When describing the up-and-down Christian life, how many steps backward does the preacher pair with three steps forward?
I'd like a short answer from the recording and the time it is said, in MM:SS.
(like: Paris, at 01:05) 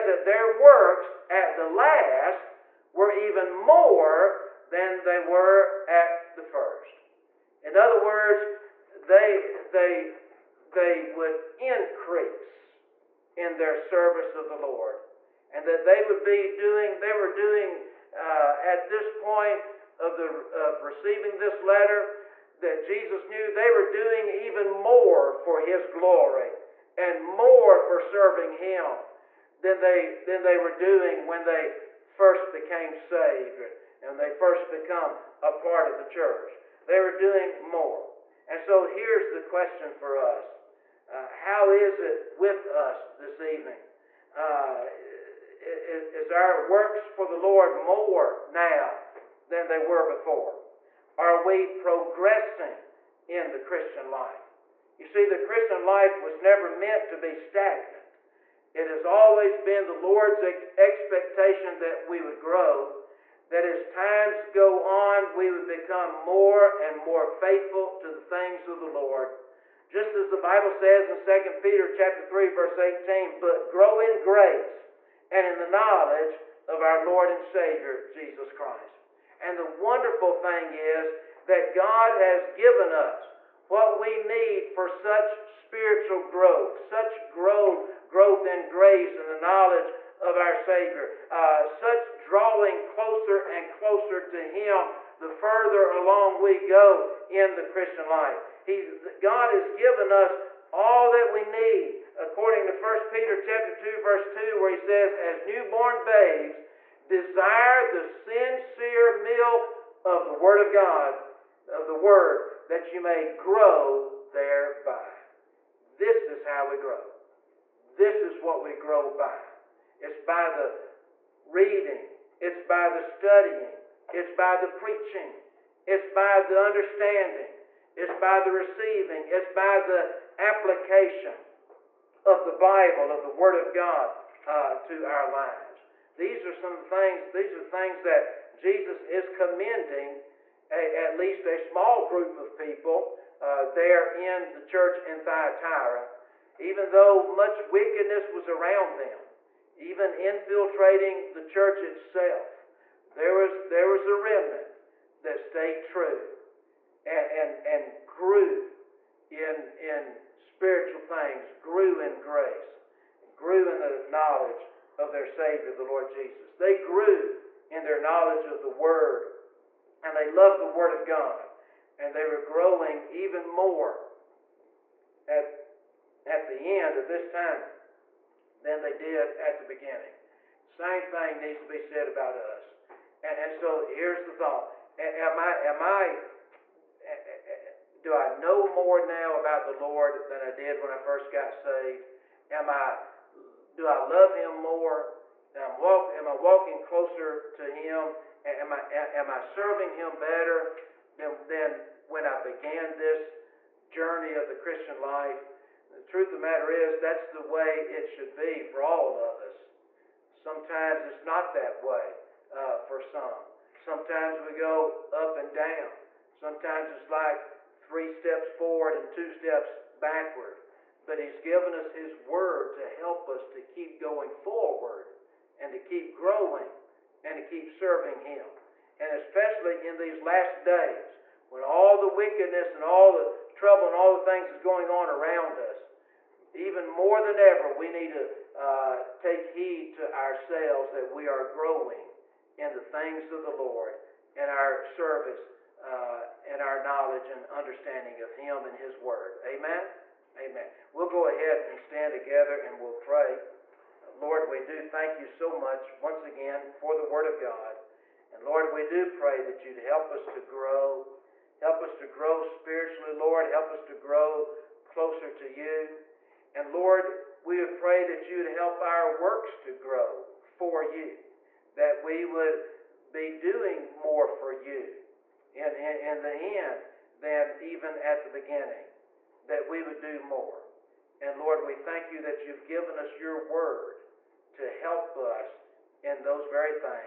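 2, at 03:39.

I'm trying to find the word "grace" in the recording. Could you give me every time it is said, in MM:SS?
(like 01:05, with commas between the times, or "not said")
01:14, 01:28, 02:42.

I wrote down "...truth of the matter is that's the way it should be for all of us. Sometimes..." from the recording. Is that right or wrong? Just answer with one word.
right.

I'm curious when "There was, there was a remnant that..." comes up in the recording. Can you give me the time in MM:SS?
02:33.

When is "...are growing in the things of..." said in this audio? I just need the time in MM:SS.
04:01.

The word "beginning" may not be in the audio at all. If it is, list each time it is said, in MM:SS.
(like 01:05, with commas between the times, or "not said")
02:59, 04:38.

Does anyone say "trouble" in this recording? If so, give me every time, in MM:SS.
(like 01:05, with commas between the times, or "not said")
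03:53.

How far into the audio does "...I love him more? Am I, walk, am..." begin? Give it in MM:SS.
03:13.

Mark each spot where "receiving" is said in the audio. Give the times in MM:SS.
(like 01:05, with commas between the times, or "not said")
00:20, 02:08.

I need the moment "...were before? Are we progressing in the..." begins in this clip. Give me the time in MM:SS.
00:49.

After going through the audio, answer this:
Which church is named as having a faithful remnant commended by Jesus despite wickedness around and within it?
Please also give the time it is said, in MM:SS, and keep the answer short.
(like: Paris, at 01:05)
Thyatira, at 02:25.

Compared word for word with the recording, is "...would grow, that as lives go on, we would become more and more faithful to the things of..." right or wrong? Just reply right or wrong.
wrong.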